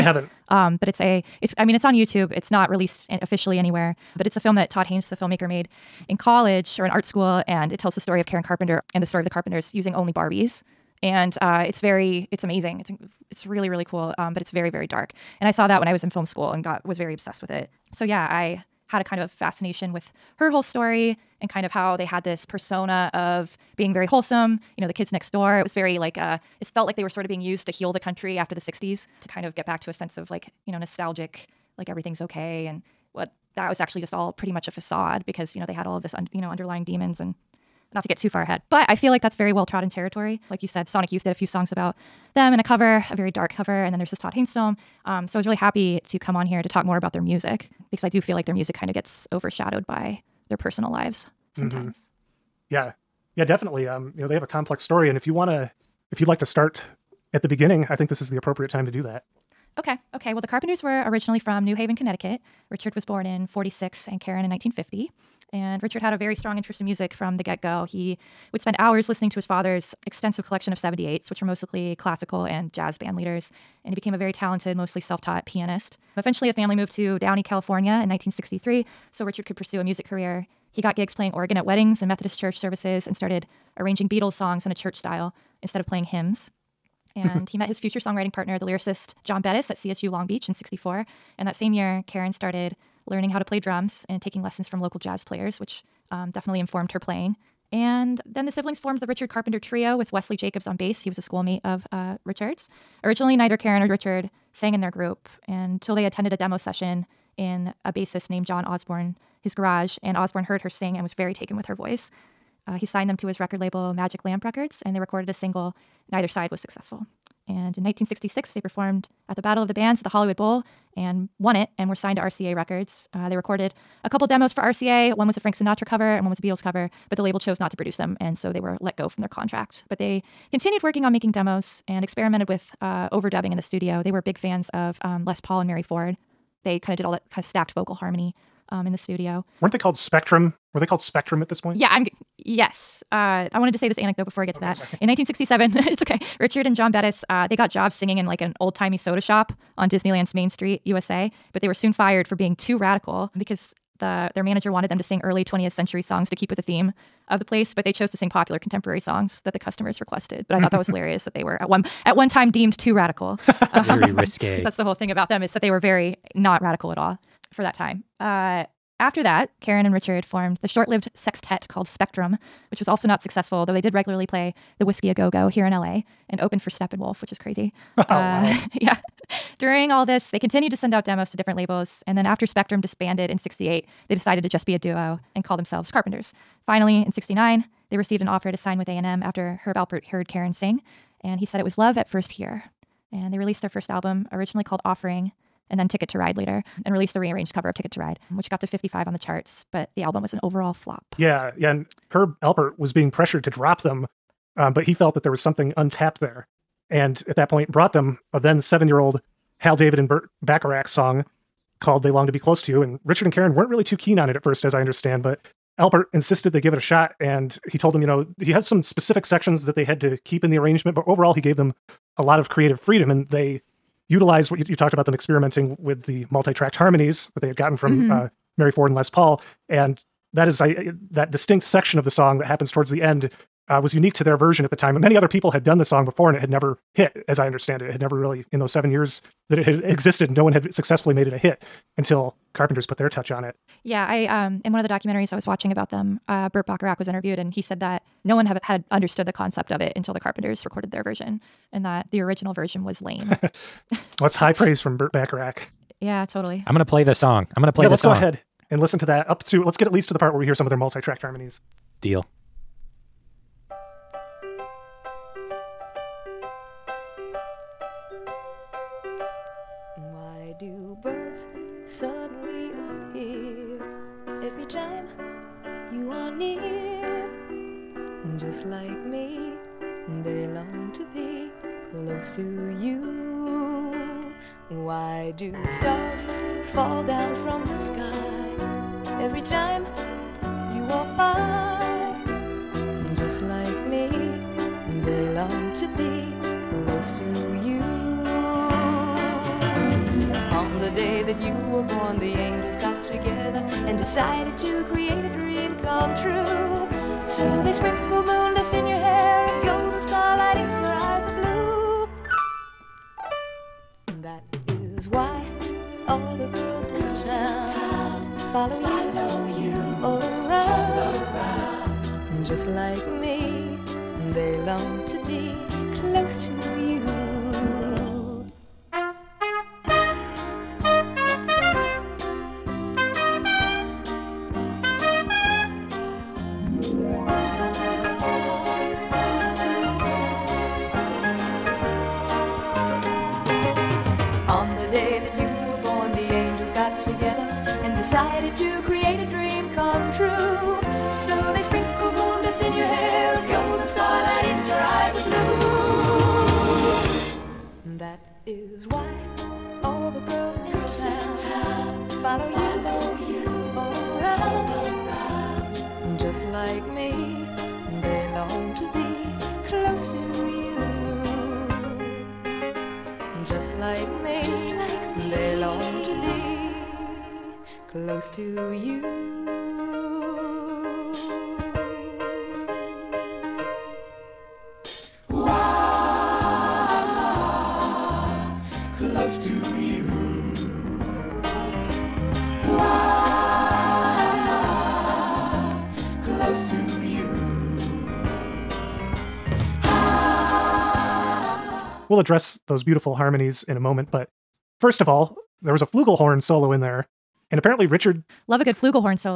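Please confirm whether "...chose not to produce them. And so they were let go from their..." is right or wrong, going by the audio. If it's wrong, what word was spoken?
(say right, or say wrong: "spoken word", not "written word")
right.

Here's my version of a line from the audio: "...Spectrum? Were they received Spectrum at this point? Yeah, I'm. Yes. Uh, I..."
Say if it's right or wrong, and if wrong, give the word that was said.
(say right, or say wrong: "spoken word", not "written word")
wrong: "called", not "received".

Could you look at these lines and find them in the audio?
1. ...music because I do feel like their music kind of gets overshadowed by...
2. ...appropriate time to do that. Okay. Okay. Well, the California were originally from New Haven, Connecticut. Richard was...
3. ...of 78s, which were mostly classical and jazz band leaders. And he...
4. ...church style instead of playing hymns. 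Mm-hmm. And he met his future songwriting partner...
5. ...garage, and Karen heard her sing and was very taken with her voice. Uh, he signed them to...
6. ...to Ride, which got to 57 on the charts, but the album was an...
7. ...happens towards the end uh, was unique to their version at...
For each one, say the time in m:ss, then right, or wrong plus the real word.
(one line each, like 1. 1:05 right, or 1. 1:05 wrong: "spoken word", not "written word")
1. 0:47 right
2. 0:58 wrong: "Carpenters", not "California"
3. 1:10 right
4. 1:24 right
5. 1:49 wrong: "Osborn", not "Karen"
6. 3:17 wrong: "55", not "57"
7. 3:52 right.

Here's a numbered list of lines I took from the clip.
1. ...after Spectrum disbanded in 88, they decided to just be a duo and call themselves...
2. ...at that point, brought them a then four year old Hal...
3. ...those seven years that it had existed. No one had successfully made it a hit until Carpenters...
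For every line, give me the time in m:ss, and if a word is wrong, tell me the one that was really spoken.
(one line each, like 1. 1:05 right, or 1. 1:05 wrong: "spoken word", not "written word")
1. 3:02 wrong: "68", not "88"
2. 3:27 wrong: "seven", not "four"
3. 3:58 right.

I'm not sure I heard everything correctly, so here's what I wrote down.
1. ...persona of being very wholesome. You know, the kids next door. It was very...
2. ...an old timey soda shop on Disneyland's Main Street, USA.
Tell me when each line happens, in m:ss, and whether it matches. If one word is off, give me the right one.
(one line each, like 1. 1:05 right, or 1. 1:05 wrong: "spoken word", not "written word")
1. 0:22 right
2. 2:28 right.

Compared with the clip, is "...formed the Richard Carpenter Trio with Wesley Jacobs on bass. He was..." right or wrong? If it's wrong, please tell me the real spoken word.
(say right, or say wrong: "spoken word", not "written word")
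right.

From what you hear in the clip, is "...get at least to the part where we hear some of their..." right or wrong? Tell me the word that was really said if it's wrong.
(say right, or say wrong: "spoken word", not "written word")
right.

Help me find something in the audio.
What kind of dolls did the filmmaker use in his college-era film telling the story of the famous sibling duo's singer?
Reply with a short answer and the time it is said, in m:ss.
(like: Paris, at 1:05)
Barbies, at 0:10.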